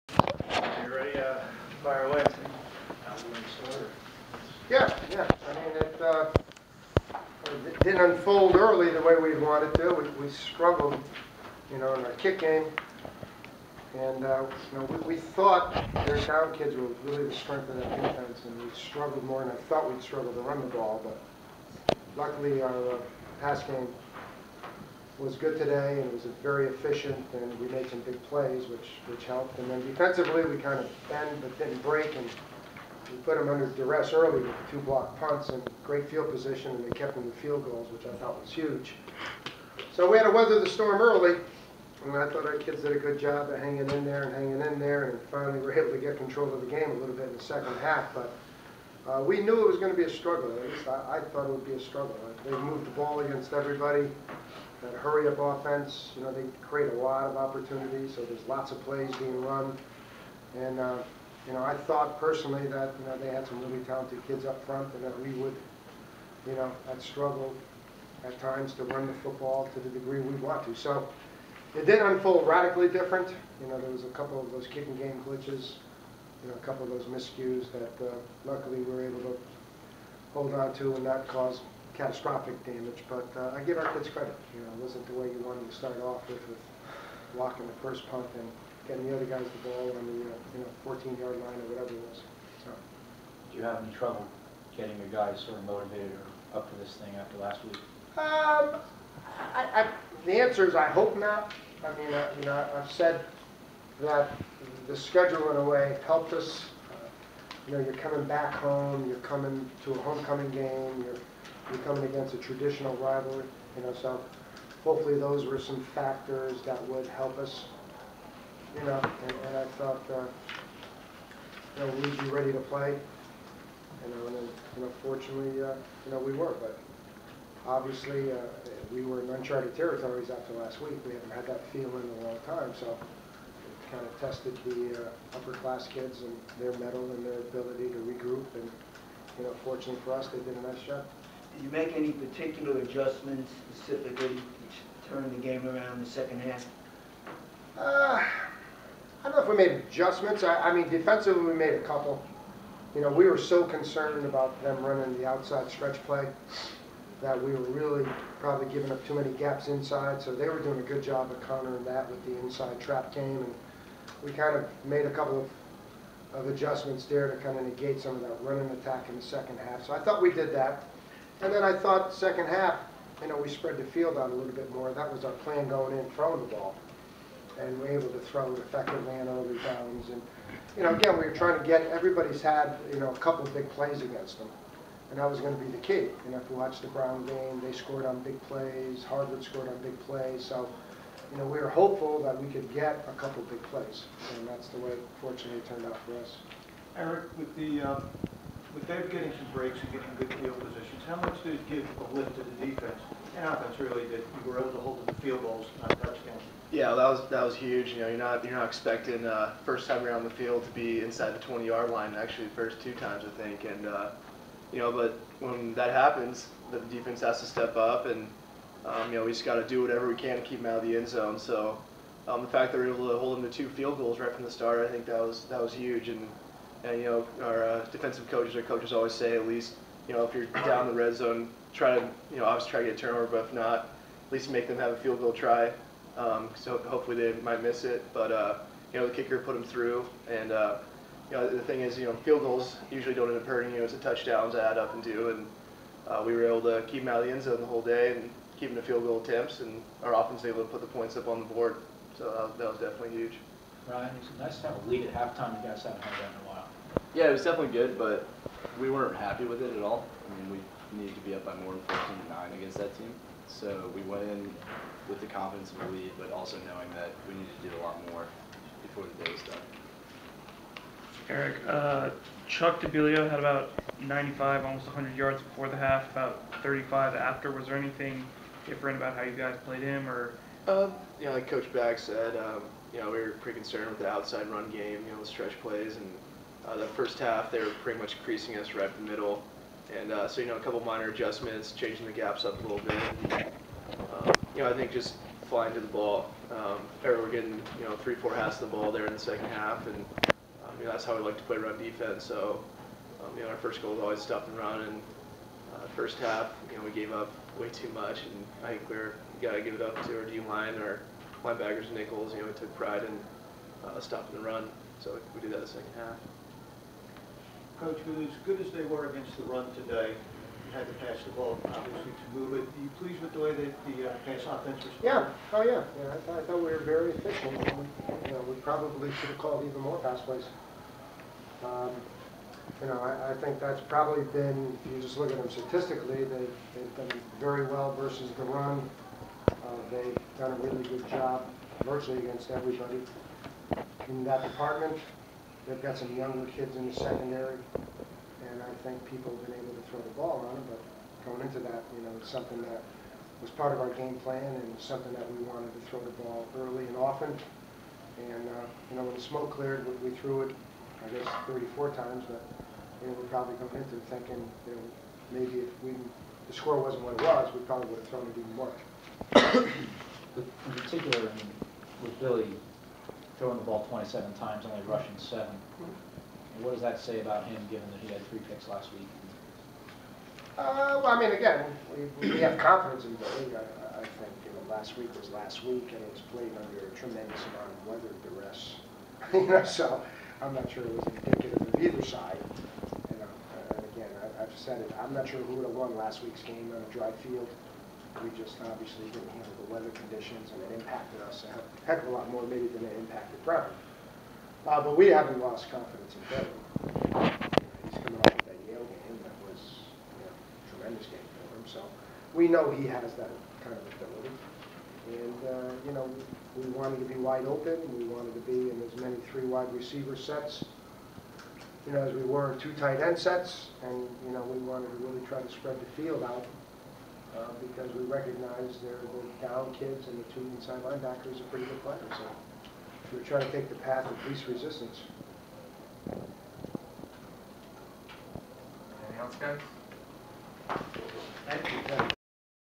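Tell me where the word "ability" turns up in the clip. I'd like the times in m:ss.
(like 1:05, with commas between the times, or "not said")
2:17, 6:53.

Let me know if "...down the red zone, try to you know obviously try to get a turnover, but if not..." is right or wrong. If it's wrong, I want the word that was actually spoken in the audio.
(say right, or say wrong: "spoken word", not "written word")
right.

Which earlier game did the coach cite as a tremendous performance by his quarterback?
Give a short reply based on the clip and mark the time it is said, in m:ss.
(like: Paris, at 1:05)
Yale, at 6:48.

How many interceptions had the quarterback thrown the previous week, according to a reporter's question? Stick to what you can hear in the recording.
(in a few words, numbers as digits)
3.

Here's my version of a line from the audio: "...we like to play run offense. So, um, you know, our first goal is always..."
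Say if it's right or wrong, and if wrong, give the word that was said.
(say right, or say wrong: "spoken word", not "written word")
wrong: "defense", not "offense".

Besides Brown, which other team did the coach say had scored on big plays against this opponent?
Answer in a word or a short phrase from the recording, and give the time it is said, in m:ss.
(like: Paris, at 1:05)
Harvard, at 3:09.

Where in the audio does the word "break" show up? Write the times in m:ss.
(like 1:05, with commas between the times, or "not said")
0:31, 3:19.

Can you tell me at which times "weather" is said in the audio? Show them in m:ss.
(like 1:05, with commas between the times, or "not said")
0:40, 6:27, 6:39.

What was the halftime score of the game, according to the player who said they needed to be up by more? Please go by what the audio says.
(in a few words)
14 to 9.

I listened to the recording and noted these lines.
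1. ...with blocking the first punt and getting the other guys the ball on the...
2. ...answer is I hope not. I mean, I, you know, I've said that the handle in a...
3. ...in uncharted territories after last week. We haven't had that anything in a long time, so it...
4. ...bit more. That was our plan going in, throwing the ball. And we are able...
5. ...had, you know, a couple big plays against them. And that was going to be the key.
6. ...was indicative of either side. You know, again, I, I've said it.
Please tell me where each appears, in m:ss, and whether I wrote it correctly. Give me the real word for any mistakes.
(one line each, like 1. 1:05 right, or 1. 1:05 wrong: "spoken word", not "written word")
1. 1:26 right
2. 1:40 wrong: "schedule", not "handle"
3. 2:09 wrong: "feeling", not "anything"
4. 2:54 right
5. 3:02 right
6. 6:30 right.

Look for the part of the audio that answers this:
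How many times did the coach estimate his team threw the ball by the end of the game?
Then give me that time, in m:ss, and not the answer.
6:01.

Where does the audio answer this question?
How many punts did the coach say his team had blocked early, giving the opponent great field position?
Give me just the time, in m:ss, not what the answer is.
0:34.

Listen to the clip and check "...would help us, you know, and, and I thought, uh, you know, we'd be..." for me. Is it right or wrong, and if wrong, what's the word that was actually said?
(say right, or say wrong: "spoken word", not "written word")
right.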